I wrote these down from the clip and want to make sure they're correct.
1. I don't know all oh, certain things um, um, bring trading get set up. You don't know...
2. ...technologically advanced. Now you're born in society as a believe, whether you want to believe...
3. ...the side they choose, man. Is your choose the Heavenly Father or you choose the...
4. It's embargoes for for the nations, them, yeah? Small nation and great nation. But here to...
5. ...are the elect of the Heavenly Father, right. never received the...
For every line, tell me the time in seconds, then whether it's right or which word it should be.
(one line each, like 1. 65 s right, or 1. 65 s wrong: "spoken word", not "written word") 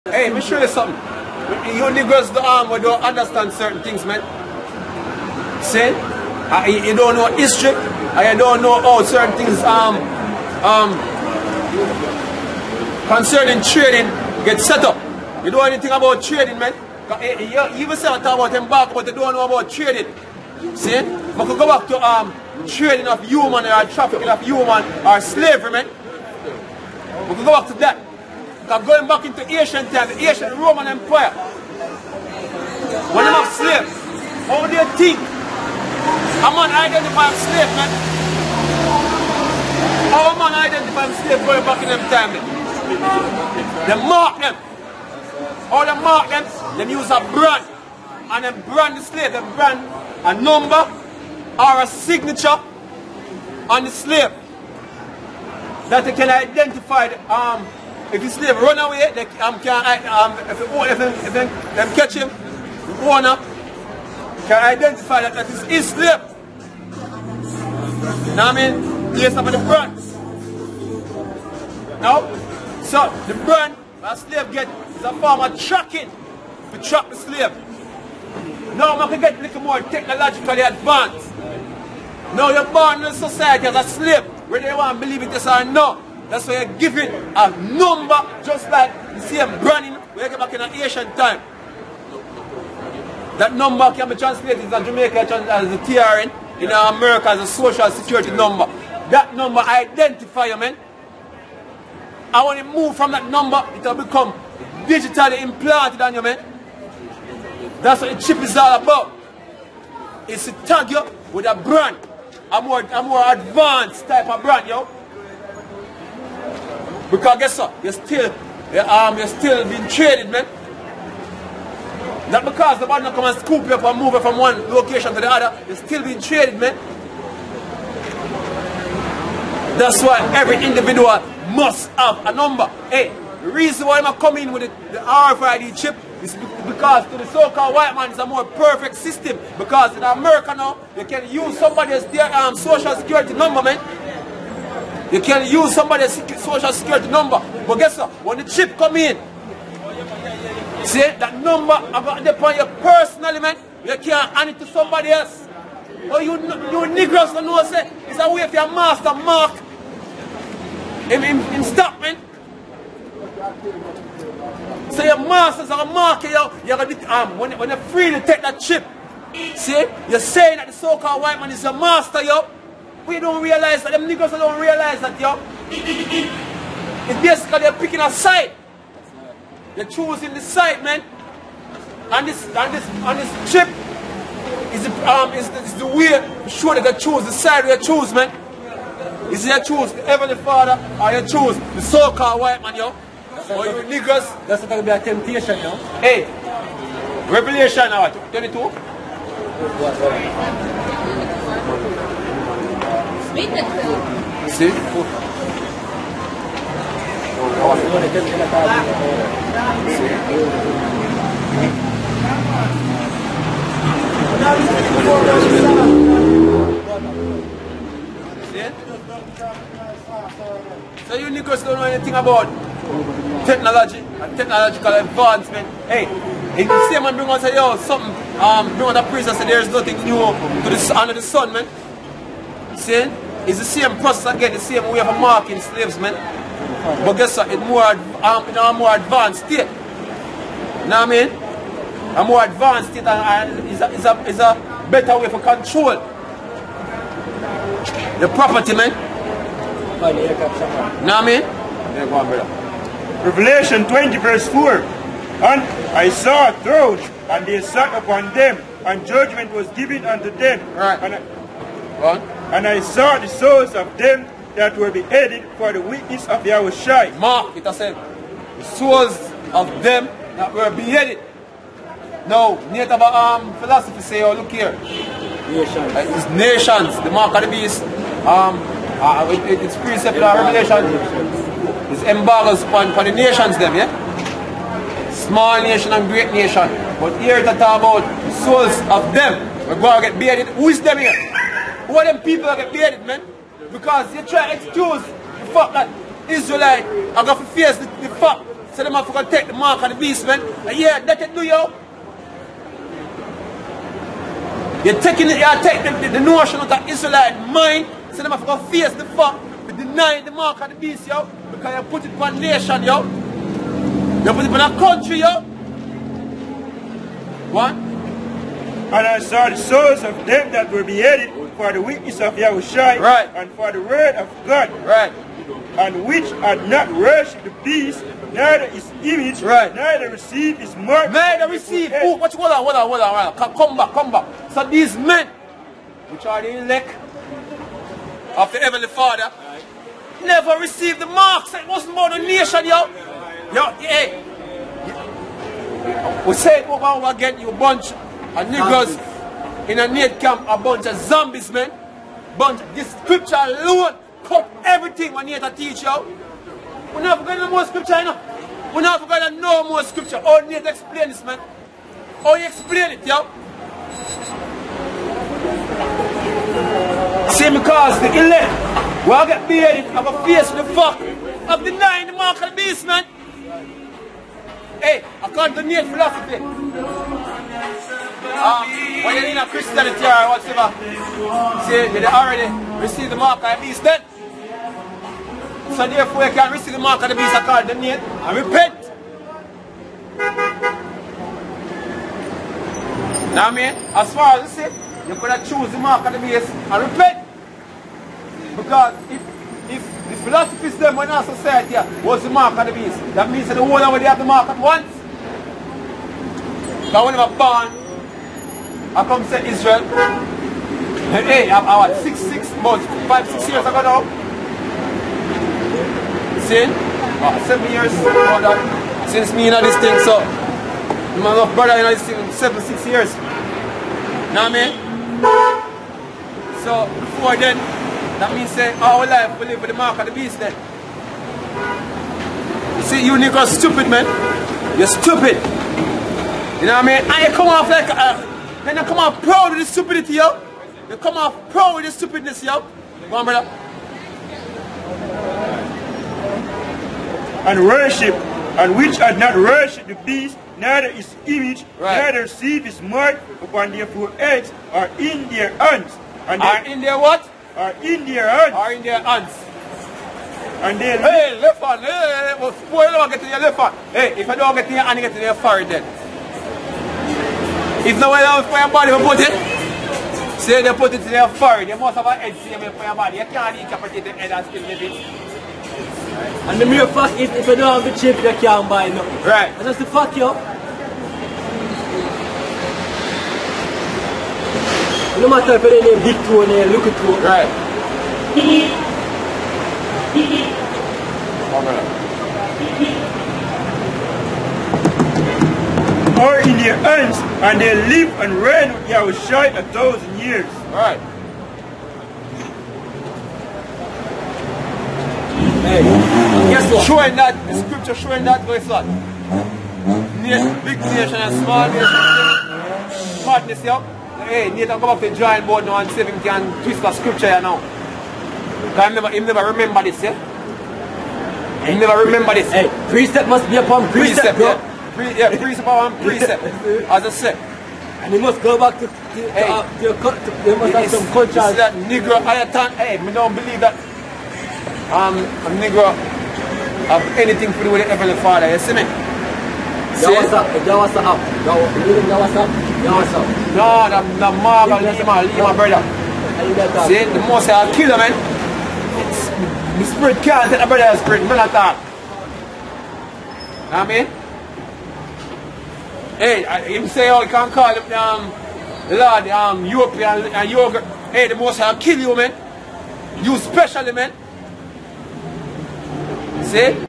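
1. 7 s wrong: "concerning", not "bring"
2. 79 s wrong: "slave", not "believe"
3. 187 s right
4. 281 s right
5. 336 s right.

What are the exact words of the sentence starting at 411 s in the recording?
Hey, I'm about six, six months, five, six years ago now.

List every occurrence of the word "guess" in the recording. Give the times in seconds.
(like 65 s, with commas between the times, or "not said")
117 s, 147 s, 237 s, 506 s.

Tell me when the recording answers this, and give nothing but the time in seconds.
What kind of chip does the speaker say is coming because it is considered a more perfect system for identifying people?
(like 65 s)
134 s.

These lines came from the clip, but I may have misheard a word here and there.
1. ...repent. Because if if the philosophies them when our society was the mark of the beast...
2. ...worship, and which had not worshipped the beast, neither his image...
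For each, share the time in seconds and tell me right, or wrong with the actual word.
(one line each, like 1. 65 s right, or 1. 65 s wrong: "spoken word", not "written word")
1. 396 s right
2. 447 s right.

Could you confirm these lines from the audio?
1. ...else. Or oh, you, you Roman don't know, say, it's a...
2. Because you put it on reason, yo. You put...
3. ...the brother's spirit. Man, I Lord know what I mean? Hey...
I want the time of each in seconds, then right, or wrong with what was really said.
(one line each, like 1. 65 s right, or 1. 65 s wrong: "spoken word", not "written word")
1. 155 s wrong: "Negroes", not "Roman"
2. 311 s wrong: "nation", not "reason"
3. 550 s wrong: "You", not "Lord".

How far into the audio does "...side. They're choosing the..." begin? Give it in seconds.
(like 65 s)
178 s.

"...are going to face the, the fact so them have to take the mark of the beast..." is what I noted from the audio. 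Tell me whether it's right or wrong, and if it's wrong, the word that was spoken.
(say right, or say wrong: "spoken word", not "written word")
right.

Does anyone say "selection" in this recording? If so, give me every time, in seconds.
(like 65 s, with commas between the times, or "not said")
not said.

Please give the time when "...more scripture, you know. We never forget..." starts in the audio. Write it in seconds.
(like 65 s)
357 s.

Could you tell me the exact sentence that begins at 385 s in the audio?
So therefore you can receive the mark of the beast called the name and repent.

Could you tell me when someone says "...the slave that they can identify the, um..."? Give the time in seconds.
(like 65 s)
53 s.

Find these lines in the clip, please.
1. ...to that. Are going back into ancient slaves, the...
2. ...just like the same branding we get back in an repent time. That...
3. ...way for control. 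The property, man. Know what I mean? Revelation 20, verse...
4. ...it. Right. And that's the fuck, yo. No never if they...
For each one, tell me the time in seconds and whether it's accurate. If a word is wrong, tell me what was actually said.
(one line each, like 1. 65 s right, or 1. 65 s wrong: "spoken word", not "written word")
1. 27 s wrong: "times", not "slaves"
2. 88 s wrong: "ancient", not "repent"
3. 245 s right
4. 478 s wrong: "matter", not "never".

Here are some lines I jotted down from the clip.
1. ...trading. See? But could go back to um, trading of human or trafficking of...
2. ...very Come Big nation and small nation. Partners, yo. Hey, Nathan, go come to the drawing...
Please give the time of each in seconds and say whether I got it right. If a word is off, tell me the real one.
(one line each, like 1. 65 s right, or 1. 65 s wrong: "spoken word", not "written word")
1. 19 s right
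2. 508 s wrong: "Near", not "Come".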